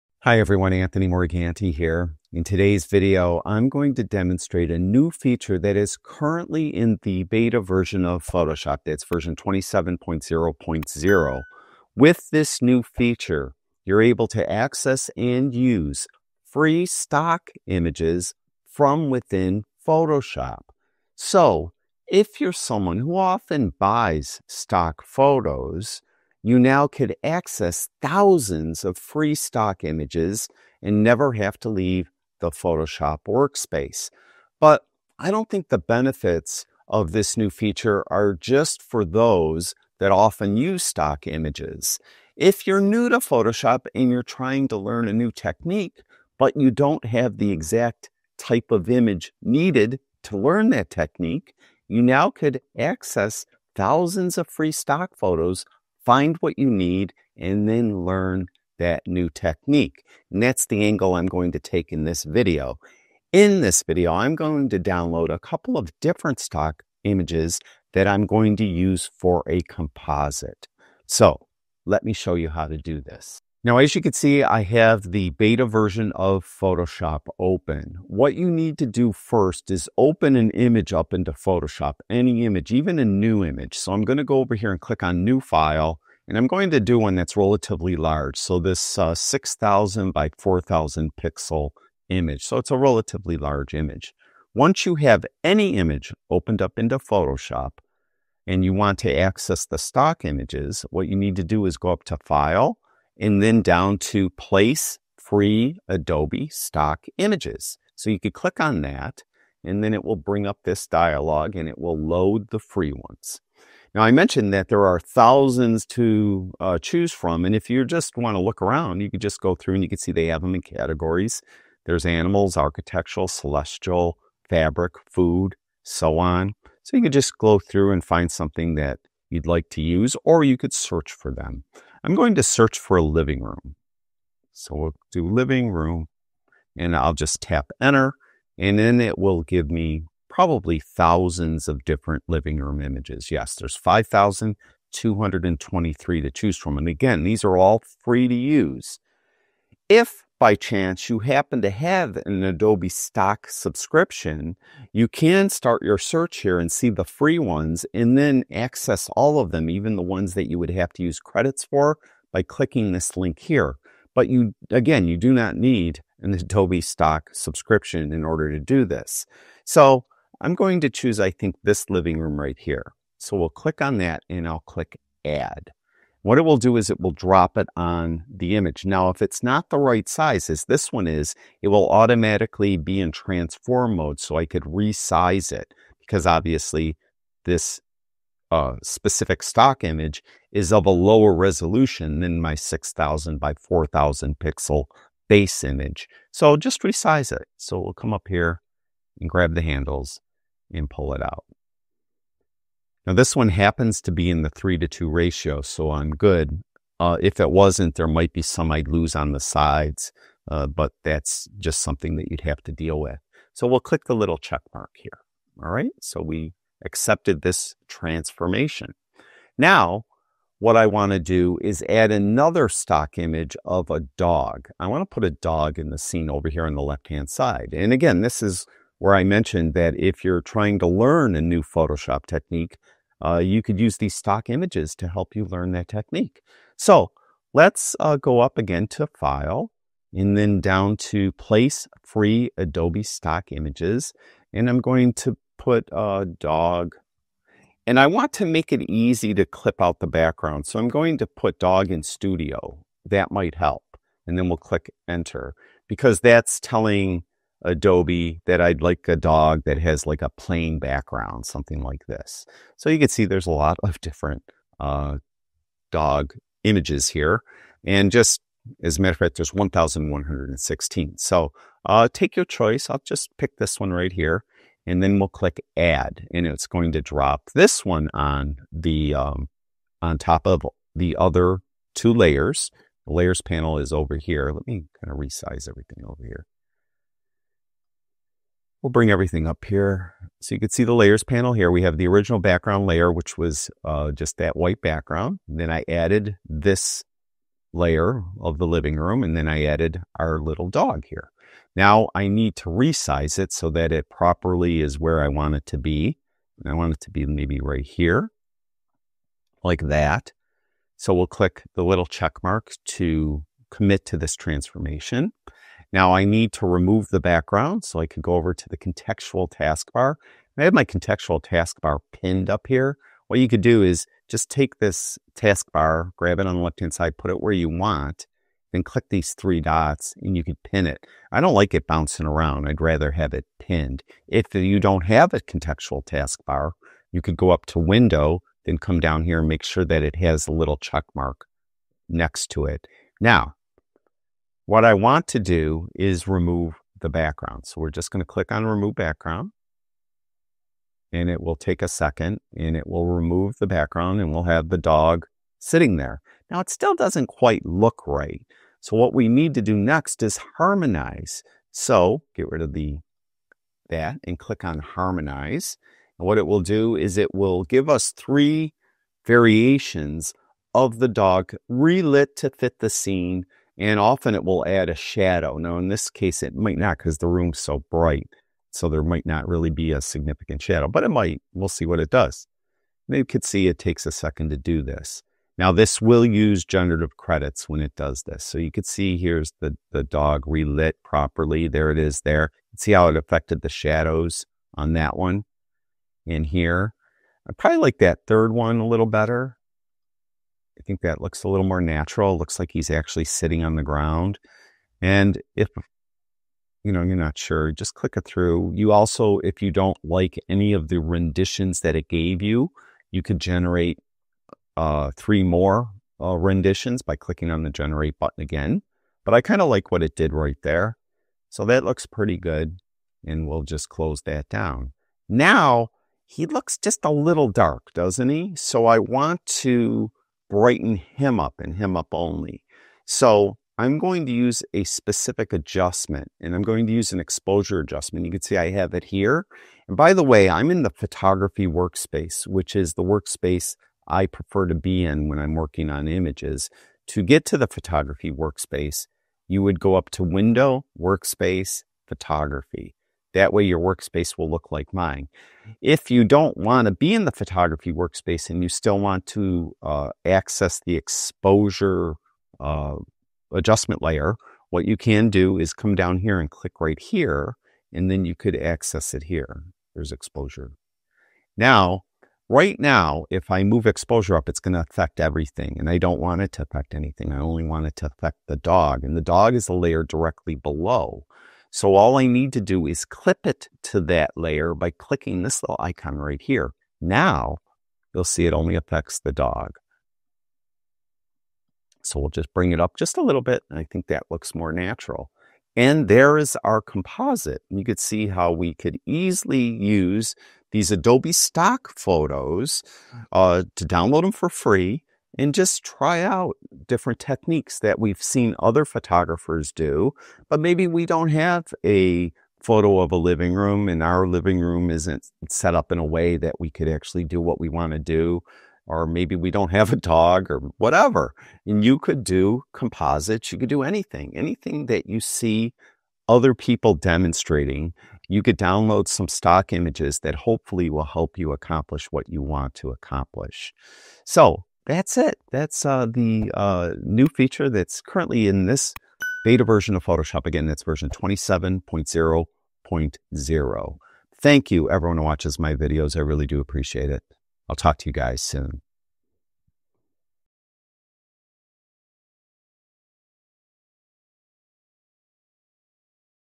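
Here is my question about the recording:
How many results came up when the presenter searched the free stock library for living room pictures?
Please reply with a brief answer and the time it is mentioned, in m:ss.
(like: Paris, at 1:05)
5,223, at 2:23.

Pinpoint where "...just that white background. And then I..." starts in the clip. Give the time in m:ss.
4:54.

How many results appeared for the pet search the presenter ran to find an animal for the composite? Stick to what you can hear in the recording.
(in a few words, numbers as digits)
1,116.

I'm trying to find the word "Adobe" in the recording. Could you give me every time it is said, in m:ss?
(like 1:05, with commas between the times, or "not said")
1:45, 2:32, 2:46, 4:02, 4:17, 8:20.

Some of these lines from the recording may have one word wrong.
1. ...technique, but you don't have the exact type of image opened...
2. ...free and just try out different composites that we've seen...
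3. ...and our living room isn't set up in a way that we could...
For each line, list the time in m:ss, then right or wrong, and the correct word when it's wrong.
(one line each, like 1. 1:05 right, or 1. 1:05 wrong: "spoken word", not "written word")
1. 0:45 wrong: "needed", not "opened"
2. 8:24 wrong: "techniques", not "composites"
3. 8:33 right.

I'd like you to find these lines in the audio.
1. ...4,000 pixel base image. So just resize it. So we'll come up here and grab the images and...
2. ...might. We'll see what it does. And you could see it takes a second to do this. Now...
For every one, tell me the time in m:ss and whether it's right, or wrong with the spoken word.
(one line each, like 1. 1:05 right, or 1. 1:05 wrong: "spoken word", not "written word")
1. 3:13 wrong: "handles", not "images"
2. 6:21 right.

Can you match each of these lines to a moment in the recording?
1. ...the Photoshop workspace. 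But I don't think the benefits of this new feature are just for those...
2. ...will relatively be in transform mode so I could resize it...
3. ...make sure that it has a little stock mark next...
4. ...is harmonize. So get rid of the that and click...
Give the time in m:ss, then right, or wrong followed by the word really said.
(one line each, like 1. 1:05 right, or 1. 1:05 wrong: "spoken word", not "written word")
1. 0:32 right
2. 3:01 wrong: "automatically", not "relatively"
3. 5:39 wrong: "check", not "stock"
4. 6:00 right.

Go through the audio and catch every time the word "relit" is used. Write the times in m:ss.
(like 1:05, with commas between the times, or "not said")
6:11, 6:30.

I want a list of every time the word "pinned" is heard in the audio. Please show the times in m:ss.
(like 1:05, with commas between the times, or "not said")
5:22, 5:33.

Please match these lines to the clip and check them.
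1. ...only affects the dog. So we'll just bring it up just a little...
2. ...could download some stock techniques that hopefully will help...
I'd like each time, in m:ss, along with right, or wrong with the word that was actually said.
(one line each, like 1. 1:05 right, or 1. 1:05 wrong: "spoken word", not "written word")
1. 8:08 right
2. 8:48 wrong: "images", not "techniques".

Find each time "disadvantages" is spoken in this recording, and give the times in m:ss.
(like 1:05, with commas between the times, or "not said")
not said.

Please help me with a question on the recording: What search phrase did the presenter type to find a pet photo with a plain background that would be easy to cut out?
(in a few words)
dog in studio.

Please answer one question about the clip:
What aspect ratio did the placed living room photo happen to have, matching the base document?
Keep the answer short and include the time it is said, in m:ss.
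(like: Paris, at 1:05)
3:2, at 3:24.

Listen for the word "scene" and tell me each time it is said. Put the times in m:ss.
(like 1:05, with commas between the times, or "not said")
3:45, 6:12.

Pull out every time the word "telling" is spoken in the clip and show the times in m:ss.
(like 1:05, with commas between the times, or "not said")
4:16.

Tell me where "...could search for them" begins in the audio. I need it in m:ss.
2:10.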